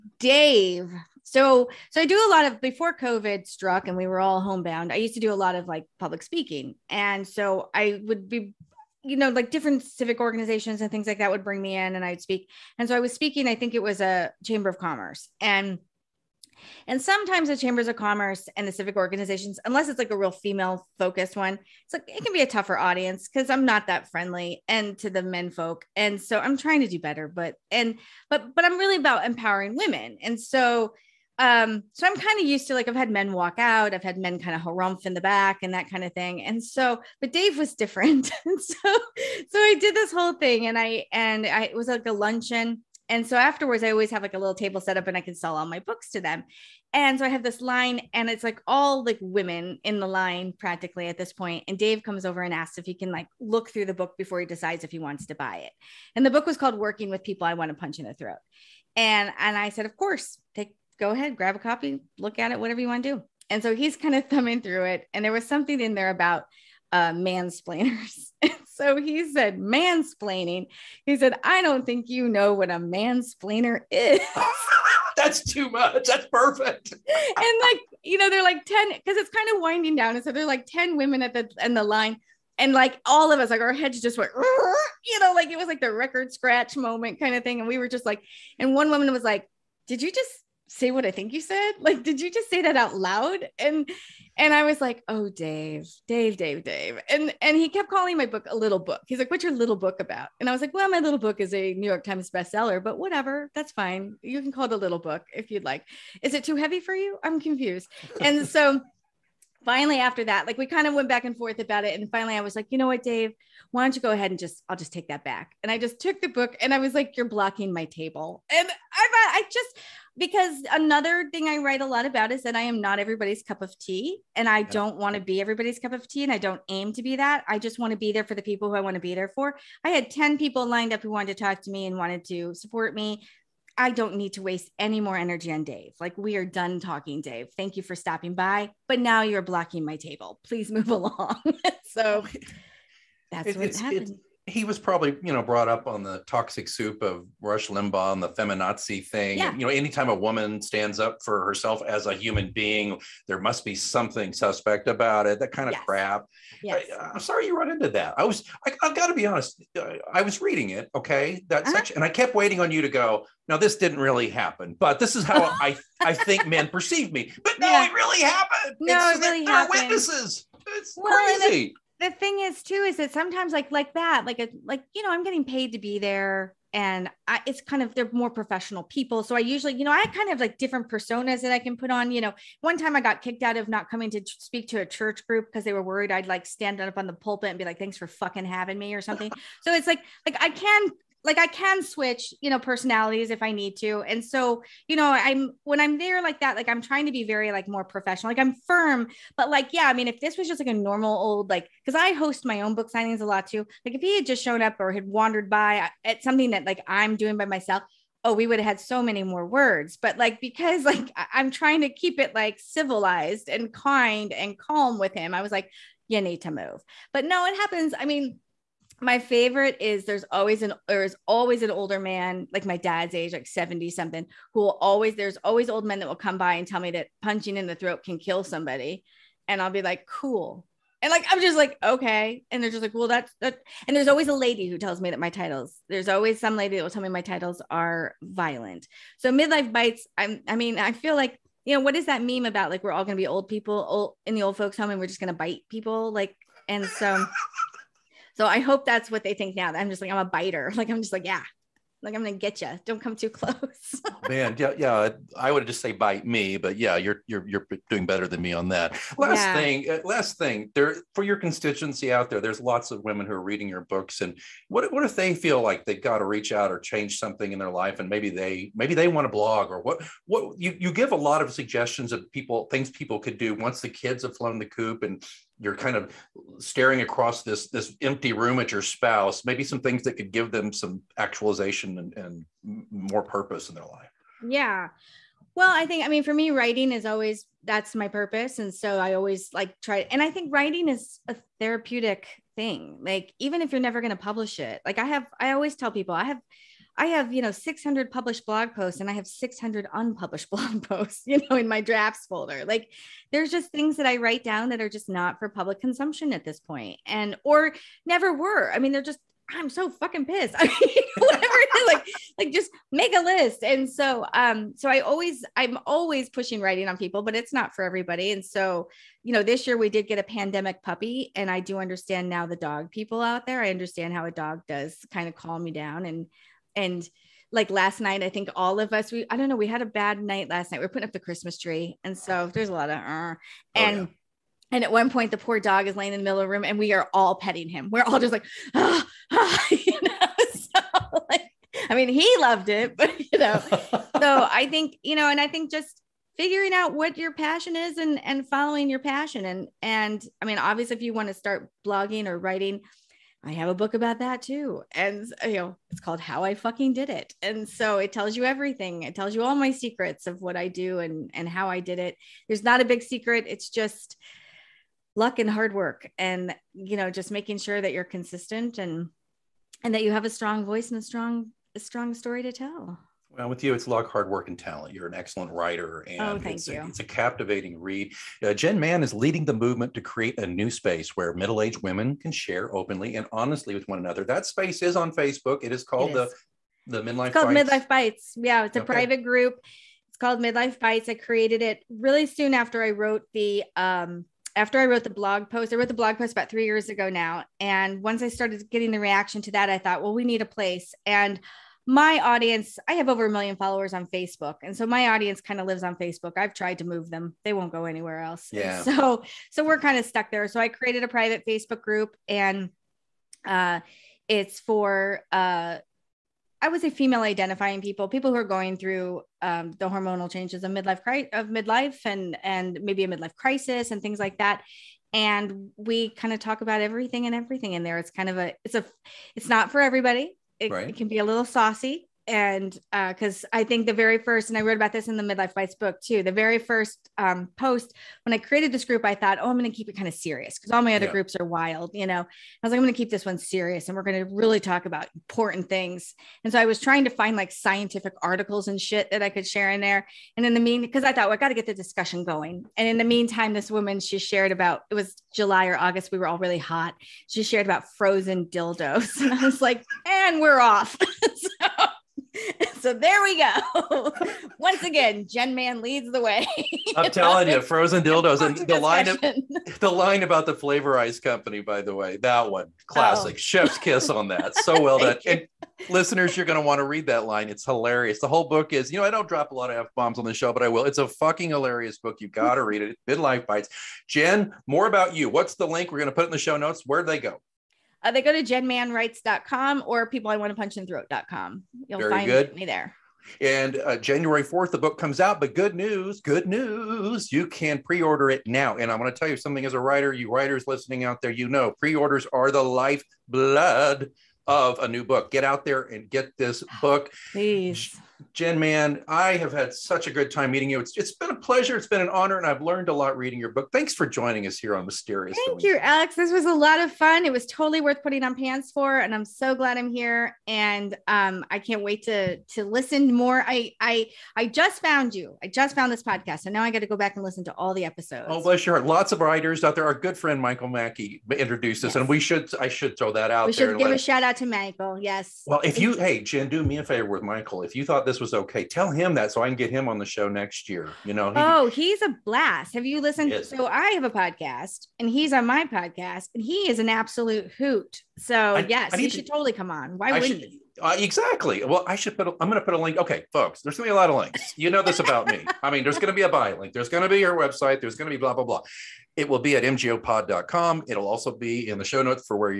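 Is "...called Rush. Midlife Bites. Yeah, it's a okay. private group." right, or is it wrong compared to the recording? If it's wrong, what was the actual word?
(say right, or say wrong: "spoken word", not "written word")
wrong: "Bites", not "Rush".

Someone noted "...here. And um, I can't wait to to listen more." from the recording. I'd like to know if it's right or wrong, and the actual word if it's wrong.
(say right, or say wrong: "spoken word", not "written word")
right.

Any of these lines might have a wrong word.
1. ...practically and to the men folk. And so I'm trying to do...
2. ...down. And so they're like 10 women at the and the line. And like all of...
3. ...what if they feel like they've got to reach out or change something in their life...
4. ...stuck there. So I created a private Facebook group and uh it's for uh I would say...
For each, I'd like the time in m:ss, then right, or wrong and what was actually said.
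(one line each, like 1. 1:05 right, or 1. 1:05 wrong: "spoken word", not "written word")
1. 0:24 wrong: "friendly", not "practically"
2. 1:19 right
3. 4:24 right
4. 6:50 right.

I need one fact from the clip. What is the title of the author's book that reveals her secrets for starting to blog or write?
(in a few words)
How I fucking did it.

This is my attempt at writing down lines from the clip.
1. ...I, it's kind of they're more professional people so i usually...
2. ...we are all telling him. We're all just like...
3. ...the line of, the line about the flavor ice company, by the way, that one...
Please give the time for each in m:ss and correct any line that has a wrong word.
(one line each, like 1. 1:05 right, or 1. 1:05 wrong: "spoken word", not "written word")
1. 2:57 right
2. 5:36 wrong: "petting", not "telling"
3. 7:48 right.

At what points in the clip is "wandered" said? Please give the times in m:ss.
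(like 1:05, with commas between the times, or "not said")
3:25.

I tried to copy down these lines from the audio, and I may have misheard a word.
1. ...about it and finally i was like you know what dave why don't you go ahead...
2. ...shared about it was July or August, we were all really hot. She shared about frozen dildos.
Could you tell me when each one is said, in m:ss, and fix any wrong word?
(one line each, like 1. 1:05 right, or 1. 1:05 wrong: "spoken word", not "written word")
1. 1:51 right
2. 7:34 right.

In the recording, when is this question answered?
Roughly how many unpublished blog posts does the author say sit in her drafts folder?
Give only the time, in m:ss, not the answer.
4:59.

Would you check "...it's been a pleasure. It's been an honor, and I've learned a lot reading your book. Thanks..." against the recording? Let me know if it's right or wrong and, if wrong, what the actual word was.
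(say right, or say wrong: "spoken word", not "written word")
right.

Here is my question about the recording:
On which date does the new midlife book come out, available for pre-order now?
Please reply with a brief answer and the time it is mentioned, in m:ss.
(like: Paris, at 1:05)
January 4th, at 8:13.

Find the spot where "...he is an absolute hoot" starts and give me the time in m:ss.
9:06.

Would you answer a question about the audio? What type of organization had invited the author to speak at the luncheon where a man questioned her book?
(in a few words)
Chamber of Commerce.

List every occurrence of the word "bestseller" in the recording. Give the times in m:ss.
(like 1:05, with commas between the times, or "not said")
1:42.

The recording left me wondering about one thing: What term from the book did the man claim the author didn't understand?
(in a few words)
mansplainer.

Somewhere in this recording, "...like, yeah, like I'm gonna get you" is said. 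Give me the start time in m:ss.
4:11.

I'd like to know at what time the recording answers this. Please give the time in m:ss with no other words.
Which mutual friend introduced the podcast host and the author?
8:50.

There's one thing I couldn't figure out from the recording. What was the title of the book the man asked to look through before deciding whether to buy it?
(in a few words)
Working with People I Want to Punch in the Throat.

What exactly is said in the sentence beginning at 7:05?
And we kind of talk about everything and everything in there.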